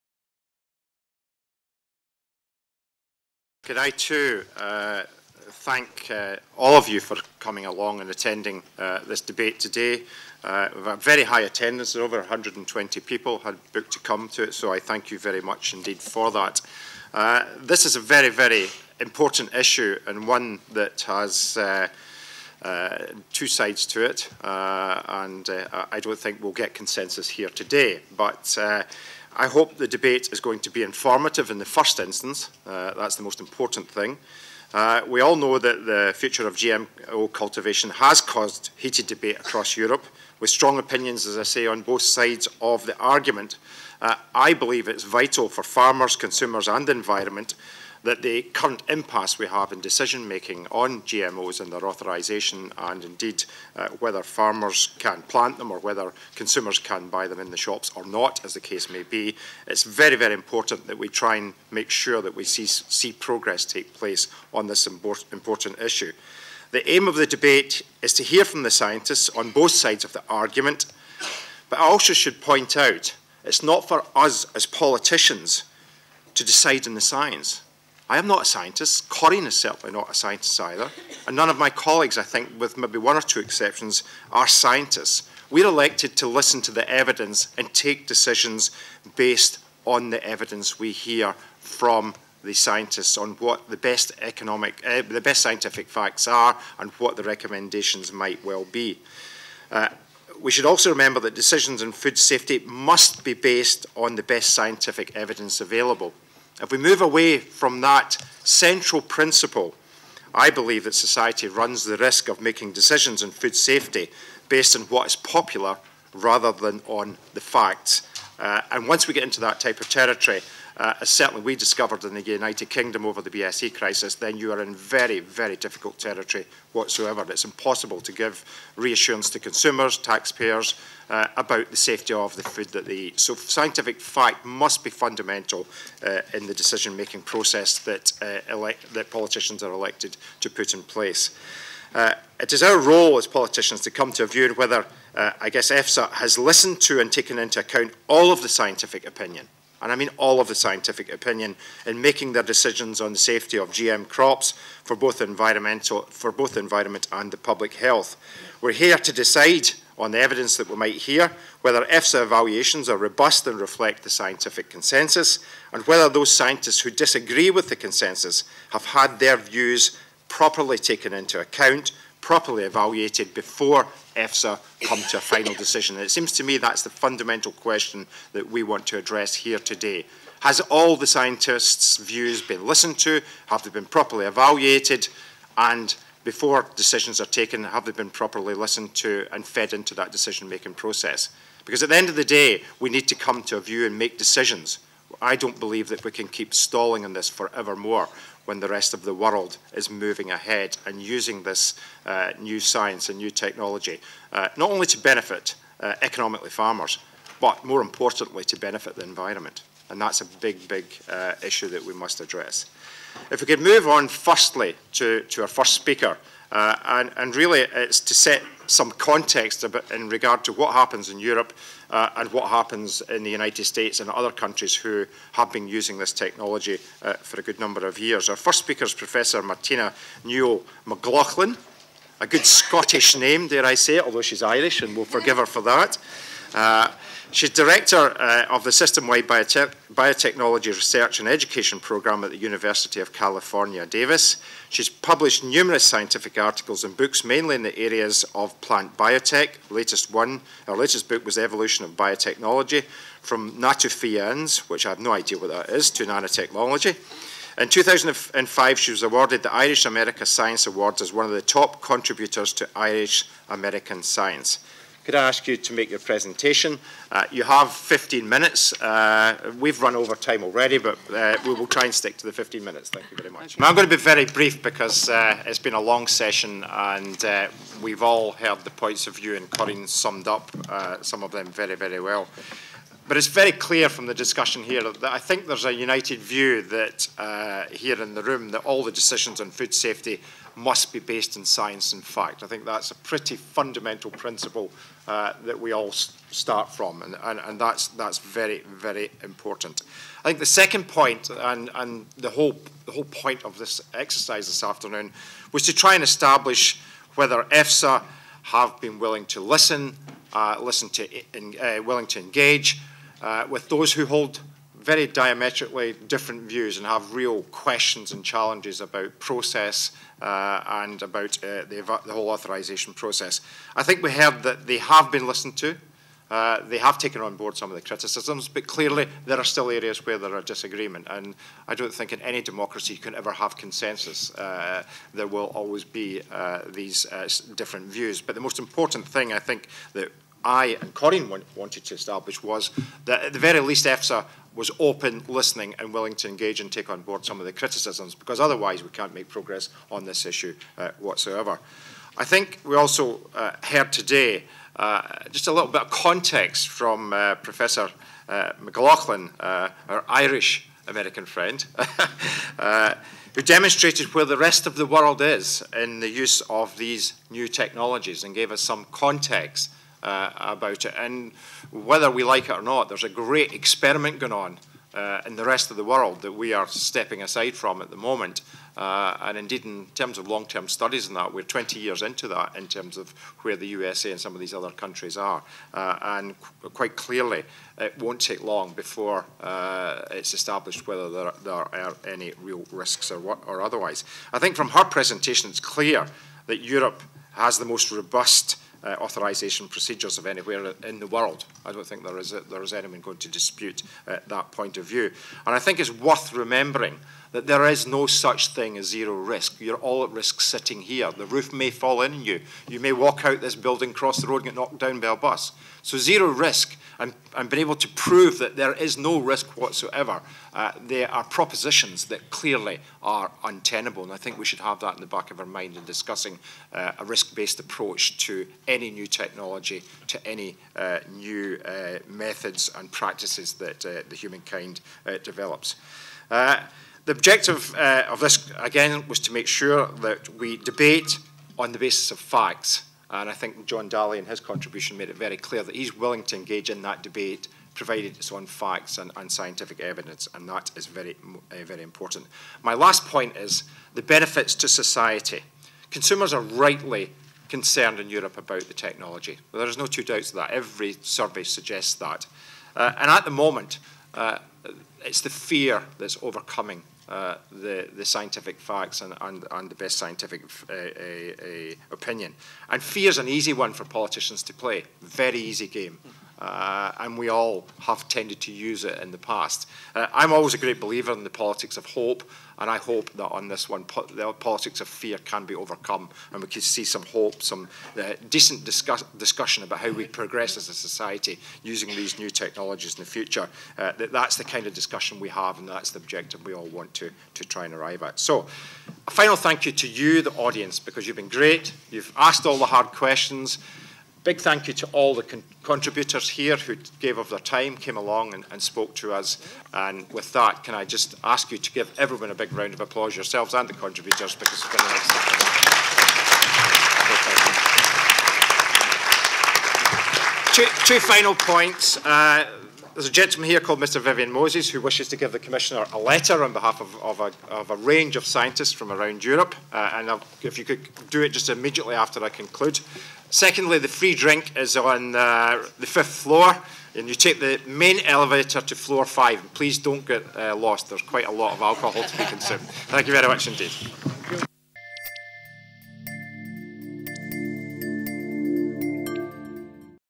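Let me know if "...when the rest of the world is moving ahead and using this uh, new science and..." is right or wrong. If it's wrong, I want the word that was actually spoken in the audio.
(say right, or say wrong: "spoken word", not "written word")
right.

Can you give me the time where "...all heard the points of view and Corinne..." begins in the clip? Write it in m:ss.
4:38.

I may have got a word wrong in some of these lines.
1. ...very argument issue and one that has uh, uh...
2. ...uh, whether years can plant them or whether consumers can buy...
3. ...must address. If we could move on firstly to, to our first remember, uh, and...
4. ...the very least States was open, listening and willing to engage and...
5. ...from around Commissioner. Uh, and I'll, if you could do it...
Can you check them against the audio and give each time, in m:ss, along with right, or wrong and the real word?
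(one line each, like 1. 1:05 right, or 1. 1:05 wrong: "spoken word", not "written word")
1. 0:18 wrong: "important", not "argument"
2. 0:53 wrong: "farmers", not "years"
3. 3:31 wrong: "speaker", not "remember"
4. 5:43 wrong: "EFSA", not "States"
5. 8:48 wrong: "Europe", not "Commissioner".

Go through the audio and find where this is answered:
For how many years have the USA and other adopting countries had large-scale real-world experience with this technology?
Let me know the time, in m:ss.
6:21.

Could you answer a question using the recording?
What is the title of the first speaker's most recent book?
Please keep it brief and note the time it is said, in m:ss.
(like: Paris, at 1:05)
Evolution of Biotechnology, at 4:11.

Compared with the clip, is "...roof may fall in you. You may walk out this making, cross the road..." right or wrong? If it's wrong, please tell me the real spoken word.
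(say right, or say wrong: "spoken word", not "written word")
wrong: "building", not "making".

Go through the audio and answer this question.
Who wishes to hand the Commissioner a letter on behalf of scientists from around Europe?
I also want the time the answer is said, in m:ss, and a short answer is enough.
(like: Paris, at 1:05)
Vivian Moses, at 8:43.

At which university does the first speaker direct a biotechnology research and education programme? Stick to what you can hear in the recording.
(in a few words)
University of California, Davis.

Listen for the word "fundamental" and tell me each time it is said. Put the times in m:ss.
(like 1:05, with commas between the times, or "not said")
2:14, 2:56, 4:53.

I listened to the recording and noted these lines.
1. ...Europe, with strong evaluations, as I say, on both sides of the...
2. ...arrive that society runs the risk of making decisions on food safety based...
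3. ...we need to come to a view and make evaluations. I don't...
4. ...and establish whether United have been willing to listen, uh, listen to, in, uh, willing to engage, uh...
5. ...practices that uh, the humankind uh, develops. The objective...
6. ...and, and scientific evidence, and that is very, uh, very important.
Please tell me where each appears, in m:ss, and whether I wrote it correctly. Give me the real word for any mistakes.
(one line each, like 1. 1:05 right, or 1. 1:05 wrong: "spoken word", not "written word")
1. 0:39 wrong: "opinions", not "evaluations"
2. 1:50 wrong: "believe", not "arrive"
3. 3:12 wrong: "decisions", not "evaluations"
4. 5:05 wrong: "EFSA", not "United"
5. 7:12 right
6. 7:28 right.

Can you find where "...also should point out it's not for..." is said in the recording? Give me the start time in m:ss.
1:11.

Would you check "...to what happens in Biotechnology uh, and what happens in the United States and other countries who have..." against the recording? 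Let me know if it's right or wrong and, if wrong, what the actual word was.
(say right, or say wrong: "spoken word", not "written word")
wrong: "Europe", not "Biotechnology".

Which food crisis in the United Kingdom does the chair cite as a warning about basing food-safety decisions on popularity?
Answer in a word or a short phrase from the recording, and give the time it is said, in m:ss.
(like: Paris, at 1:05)
BSE crisis, at 2:03.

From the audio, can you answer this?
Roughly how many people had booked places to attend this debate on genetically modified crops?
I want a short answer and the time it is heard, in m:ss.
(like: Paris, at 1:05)
over 120, at 0:11.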